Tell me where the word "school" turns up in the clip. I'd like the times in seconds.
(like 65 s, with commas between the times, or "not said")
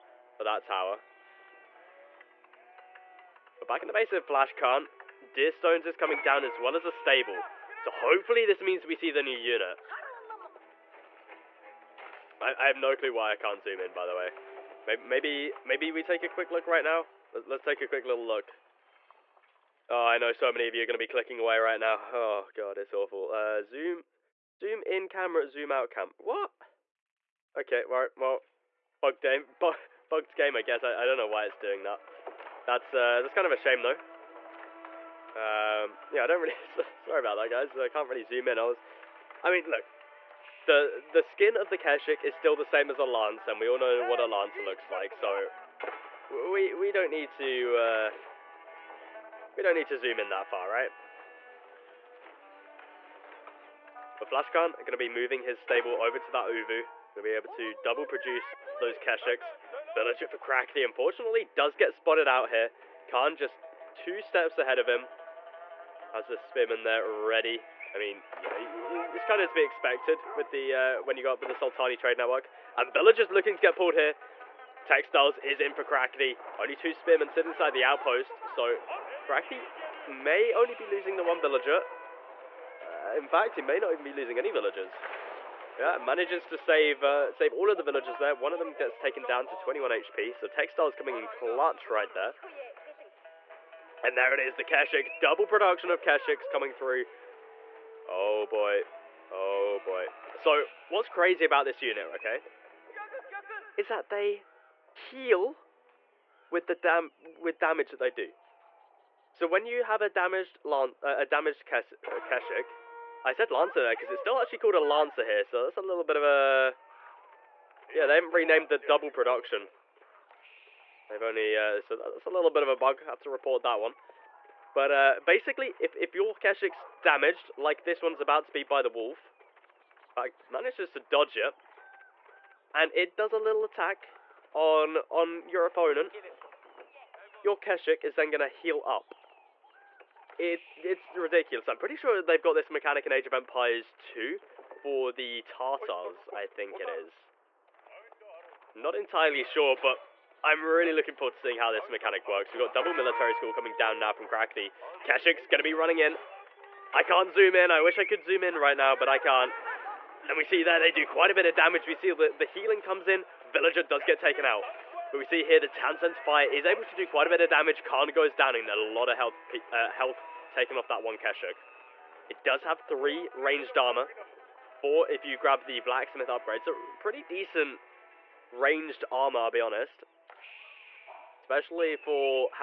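153 s.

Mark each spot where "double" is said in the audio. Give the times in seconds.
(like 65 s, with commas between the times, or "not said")
57 s, 95 s, 118 s, 152 s.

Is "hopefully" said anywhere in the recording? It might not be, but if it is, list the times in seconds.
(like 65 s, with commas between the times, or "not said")
7 s.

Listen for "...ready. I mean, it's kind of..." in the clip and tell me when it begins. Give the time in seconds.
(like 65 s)
67 s.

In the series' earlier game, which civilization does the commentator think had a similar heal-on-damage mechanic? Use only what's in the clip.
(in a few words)
Tartars.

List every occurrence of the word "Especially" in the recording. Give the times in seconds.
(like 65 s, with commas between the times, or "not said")
181 s.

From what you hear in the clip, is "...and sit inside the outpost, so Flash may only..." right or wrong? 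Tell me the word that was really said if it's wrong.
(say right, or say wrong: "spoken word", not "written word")
wrong: "Crackety", not "Flash".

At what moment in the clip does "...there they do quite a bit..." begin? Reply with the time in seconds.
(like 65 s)
160 s.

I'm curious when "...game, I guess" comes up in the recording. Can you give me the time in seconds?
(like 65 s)
30 s.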